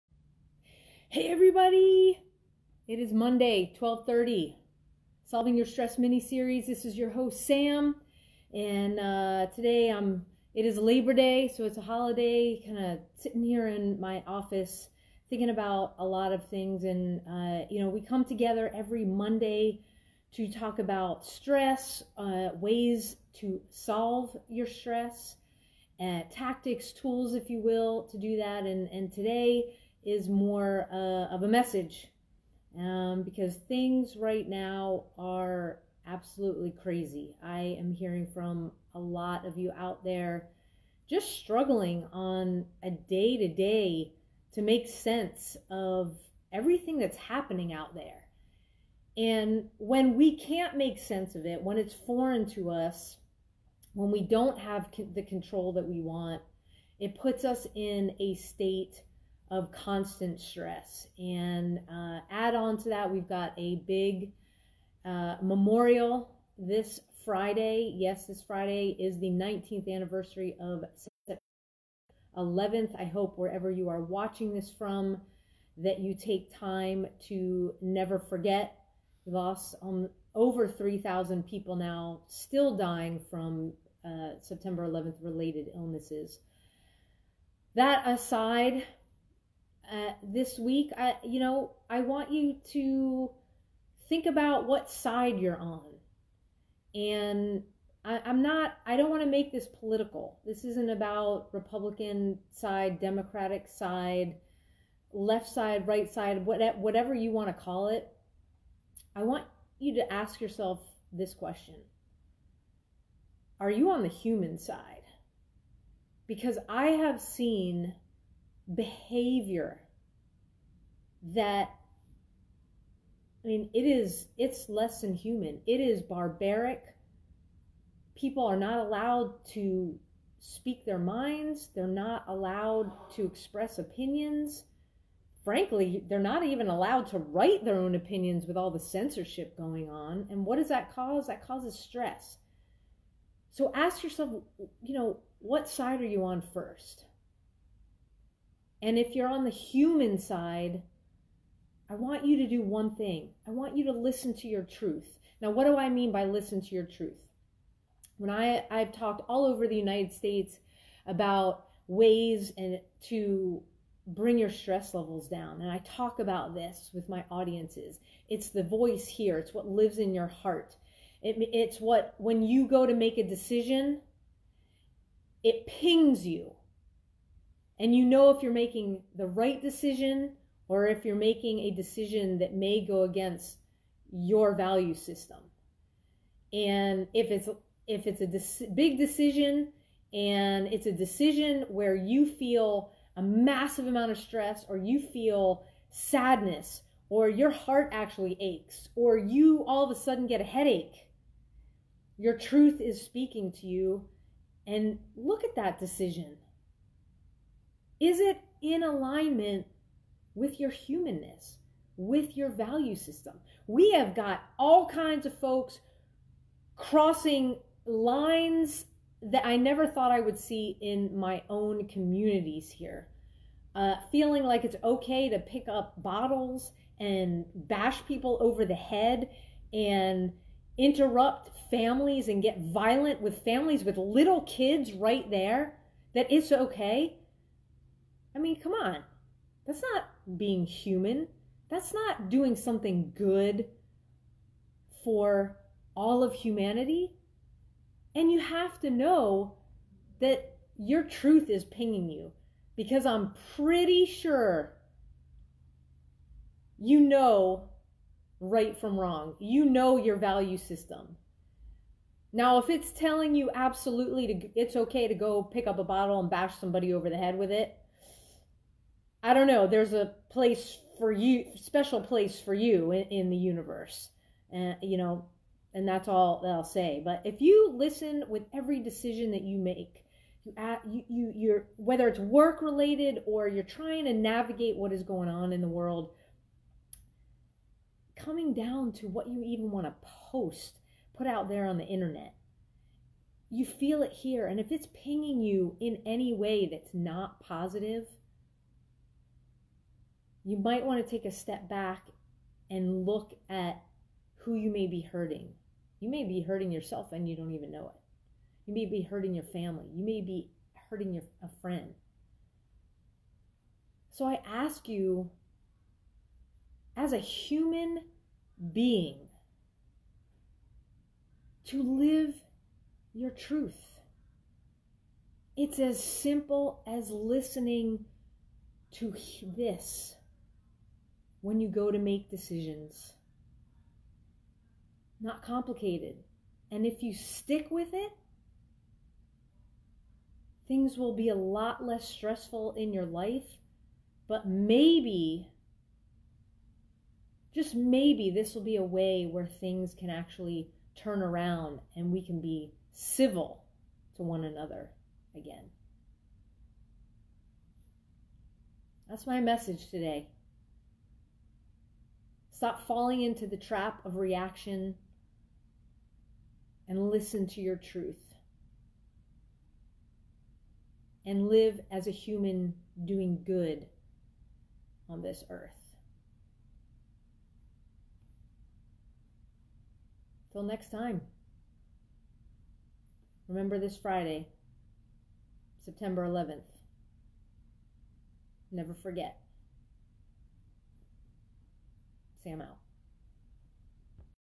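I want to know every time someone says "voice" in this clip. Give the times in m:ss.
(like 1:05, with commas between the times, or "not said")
2:48.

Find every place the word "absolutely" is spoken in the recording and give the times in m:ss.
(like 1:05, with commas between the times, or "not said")
0:36, 4:23.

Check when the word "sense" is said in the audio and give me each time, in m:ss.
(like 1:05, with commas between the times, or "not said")
0:44, 0:50.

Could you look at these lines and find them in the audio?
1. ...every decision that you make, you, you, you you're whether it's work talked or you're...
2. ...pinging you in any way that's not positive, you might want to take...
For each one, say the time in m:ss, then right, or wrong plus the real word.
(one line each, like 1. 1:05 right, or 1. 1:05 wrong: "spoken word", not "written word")
1. 4:38 wrong: "related", not "talked"
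2. 4:54 right.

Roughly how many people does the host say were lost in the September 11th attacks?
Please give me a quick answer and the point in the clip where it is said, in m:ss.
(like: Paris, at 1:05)
over 3,000, at 1:20.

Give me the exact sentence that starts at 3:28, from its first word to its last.
Is it in alignment with your humanness, with your value system?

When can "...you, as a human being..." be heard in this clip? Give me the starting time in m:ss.
5:14.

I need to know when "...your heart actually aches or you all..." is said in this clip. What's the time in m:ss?
3:17.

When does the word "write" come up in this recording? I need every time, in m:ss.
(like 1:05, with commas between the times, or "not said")
2:17.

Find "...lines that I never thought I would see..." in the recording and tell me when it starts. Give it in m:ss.
3:37.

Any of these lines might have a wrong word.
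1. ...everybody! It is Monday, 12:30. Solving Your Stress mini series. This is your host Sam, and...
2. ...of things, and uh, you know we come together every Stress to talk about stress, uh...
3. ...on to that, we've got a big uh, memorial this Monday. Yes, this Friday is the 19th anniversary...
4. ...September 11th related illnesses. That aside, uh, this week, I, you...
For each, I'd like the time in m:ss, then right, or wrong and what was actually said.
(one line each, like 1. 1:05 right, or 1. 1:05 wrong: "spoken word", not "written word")
1. 0:01 right
2. 0:16 wrong: "Monday", not "Stress"
3. 1:02 wrong: "Friday", not "Monday"
4. 1:24 right.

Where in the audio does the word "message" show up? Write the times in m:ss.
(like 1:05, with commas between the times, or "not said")
0:31, 5:59.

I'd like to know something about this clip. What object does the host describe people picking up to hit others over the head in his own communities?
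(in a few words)
bottles.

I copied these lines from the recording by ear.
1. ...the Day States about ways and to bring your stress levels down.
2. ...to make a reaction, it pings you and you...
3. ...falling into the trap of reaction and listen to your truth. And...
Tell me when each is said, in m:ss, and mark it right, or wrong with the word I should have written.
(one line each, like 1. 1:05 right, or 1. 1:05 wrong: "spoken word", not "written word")
1. 2:39 wrong: "United", not "Day"
2. 2:52 wrong: "decision", not "reaction"
3. 6:02 right.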